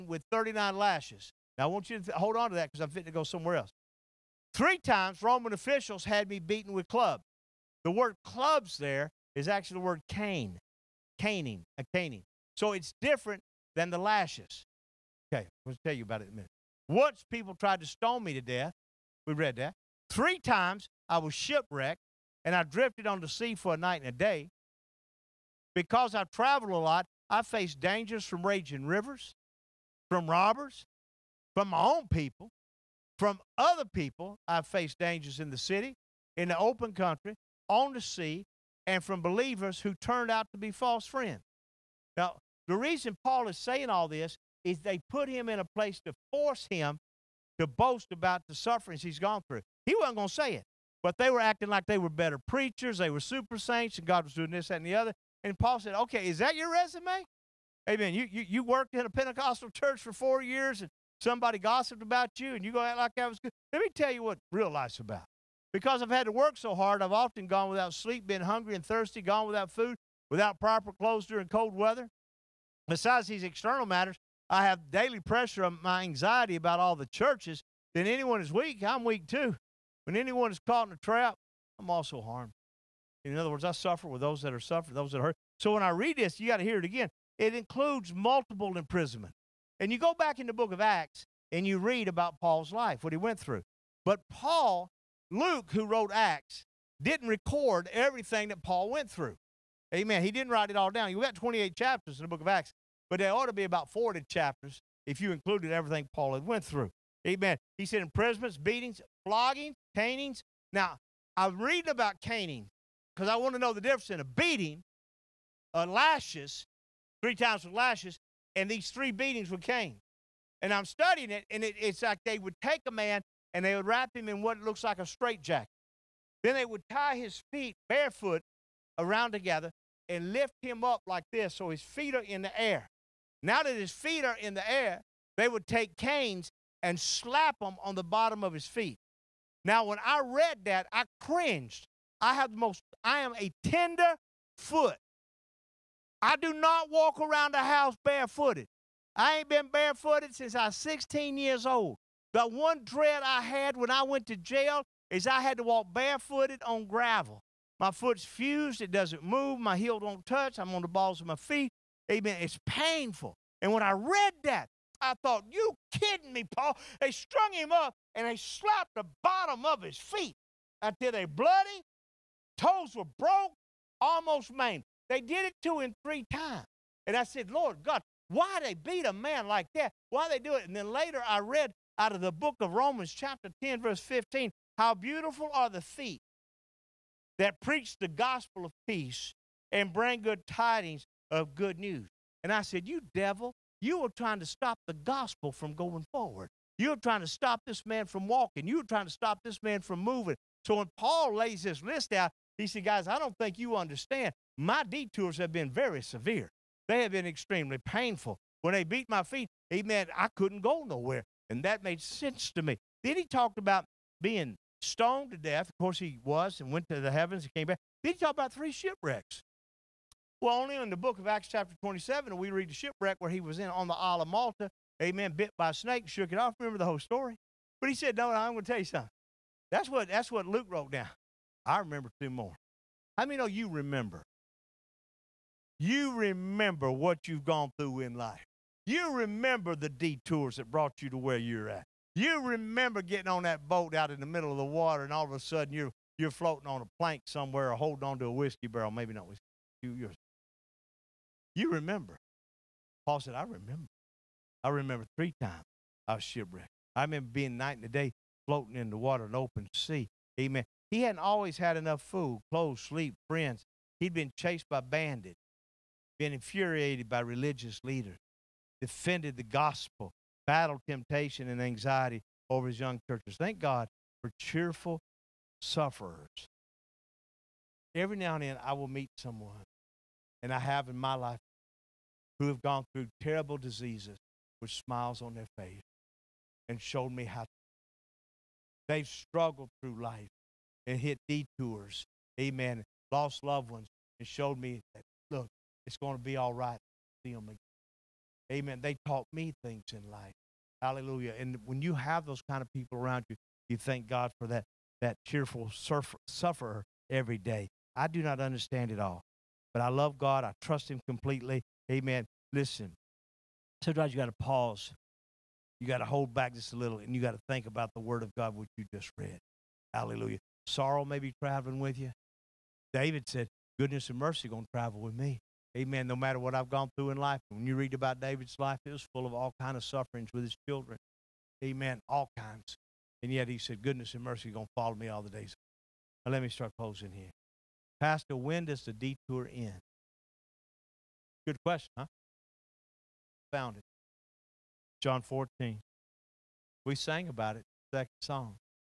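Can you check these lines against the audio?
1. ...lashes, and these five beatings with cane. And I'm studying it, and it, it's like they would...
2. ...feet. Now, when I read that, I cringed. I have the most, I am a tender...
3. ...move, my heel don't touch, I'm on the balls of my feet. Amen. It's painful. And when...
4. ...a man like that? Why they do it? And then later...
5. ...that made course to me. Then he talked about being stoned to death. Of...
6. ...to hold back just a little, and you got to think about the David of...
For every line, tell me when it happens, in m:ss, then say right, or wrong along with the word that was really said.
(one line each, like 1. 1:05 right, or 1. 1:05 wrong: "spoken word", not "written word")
1. 1:57 wrong: "three", not "five"
2. 2:18 right
3. 2:39 right
4. 2:59 right
5. 3:31 wrong: "sense", not "course"
6. 5:15 wrong: "Word", not "David".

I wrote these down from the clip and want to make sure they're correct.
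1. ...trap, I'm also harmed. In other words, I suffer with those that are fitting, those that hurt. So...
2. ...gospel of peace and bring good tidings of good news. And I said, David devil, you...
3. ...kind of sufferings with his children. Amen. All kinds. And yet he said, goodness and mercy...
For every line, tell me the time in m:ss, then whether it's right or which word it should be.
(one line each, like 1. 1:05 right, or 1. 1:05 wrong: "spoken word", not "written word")
1. 1:20 wrong: "suffering", not "fitting"
2. 3:08 wrong: "You", not "David"
3. 5:29 right.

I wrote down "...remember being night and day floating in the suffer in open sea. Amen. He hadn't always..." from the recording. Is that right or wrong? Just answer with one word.
wrong.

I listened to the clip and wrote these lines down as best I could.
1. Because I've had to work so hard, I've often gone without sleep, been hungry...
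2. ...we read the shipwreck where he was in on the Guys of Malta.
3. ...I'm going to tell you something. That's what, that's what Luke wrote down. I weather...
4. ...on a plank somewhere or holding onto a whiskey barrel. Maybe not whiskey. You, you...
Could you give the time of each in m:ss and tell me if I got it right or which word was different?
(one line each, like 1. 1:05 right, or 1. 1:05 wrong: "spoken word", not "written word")
1. 1:05 right
2. 3:42 wrong: "Isle", not "Guys"
3. 3:48 wrong: "remember", not "weather"
4. 4:06 right.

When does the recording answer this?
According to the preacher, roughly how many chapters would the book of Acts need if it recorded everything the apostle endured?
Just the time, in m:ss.
1:43.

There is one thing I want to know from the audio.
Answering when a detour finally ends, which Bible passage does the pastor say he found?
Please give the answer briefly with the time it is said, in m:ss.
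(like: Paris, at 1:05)
John 14, at 5:45.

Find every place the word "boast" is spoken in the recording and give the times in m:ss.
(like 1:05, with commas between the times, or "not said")
0:47.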